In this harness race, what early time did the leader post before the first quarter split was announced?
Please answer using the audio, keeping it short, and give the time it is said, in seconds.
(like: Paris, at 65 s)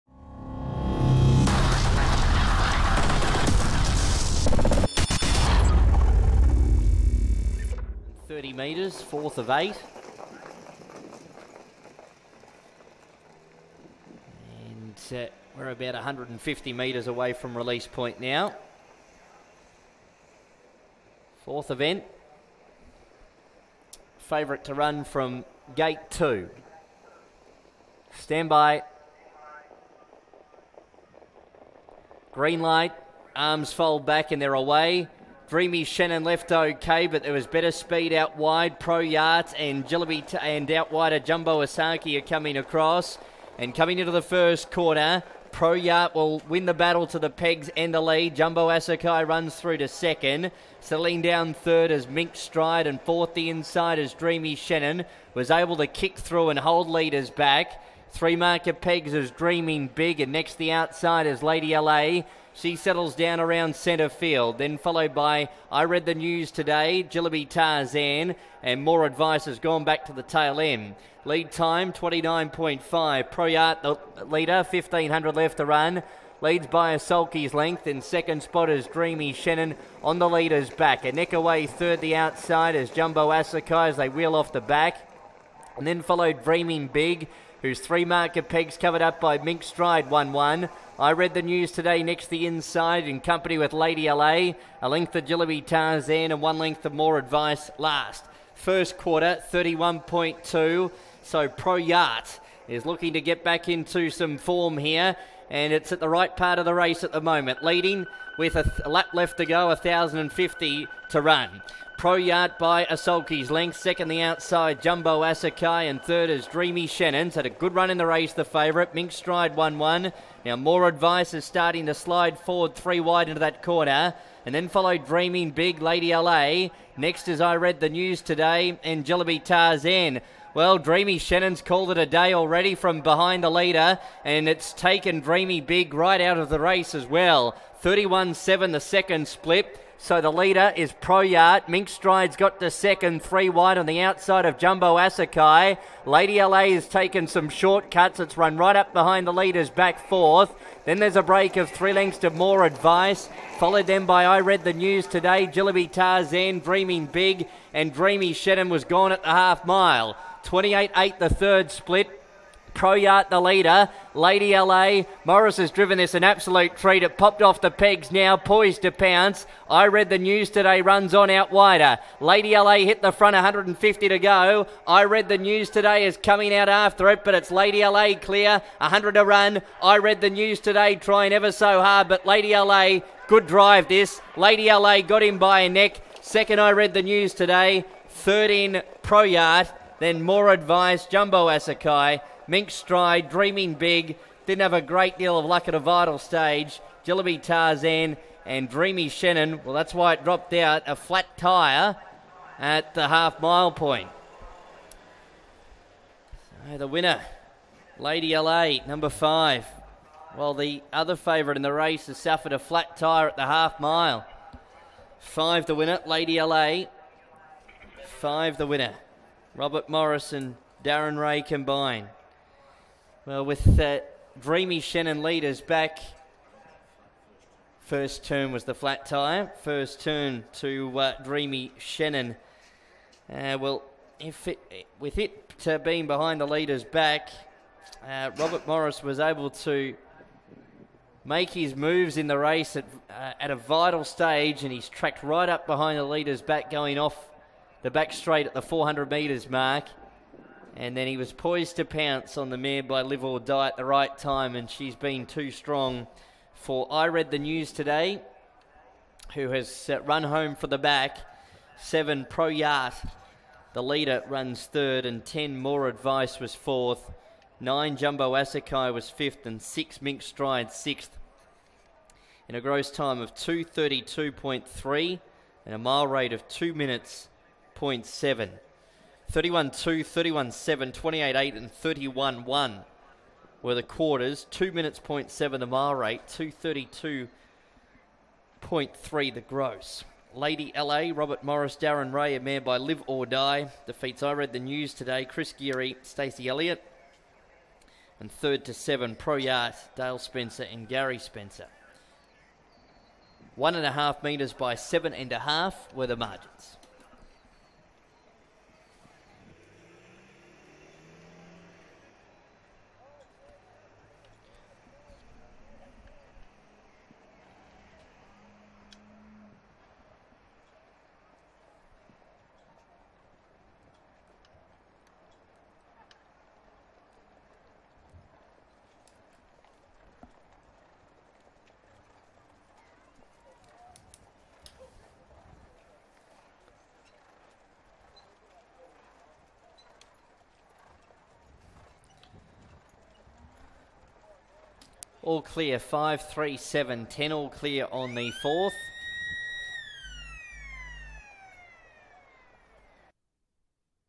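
29.5, at 71 s.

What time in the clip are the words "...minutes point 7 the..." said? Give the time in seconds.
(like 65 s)
284 s.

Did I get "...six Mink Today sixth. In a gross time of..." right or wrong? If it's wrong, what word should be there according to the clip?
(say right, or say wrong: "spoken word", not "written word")
wrong: "Stride", not "Today".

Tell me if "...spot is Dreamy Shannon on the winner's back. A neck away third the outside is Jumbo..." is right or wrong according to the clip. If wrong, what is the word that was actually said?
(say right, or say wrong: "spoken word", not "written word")
wrong: "leader", not "winner".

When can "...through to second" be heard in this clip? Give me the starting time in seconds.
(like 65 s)
49 s.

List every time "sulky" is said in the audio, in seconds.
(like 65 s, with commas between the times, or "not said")
76 s, 112 s.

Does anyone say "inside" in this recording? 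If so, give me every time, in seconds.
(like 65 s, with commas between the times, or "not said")
53 s, 92 s.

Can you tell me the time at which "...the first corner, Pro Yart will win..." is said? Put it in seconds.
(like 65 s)
44 s.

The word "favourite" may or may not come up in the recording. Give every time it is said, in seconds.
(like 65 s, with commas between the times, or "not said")
24 s, 118 s, 211 s.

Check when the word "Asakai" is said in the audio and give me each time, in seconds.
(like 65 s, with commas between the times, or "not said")
41 s, 48 s, 83 s, 115 s, 144 s, 191 s, 268 s.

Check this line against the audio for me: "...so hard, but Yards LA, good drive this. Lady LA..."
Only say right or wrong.
wrong.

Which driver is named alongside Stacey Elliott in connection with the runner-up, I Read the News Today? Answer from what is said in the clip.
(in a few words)
Chris Geary.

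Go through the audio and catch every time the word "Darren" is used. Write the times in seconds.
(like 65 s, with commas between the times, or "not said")
220 s, 291 s.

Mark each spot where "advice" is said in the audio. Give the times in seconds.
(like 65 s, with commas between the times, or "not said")
69 s, 97 s, 120 s, 152 s, 190 s, 265 s.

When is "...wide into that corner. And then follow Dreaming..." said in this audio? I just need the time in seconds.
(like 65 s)
123 s.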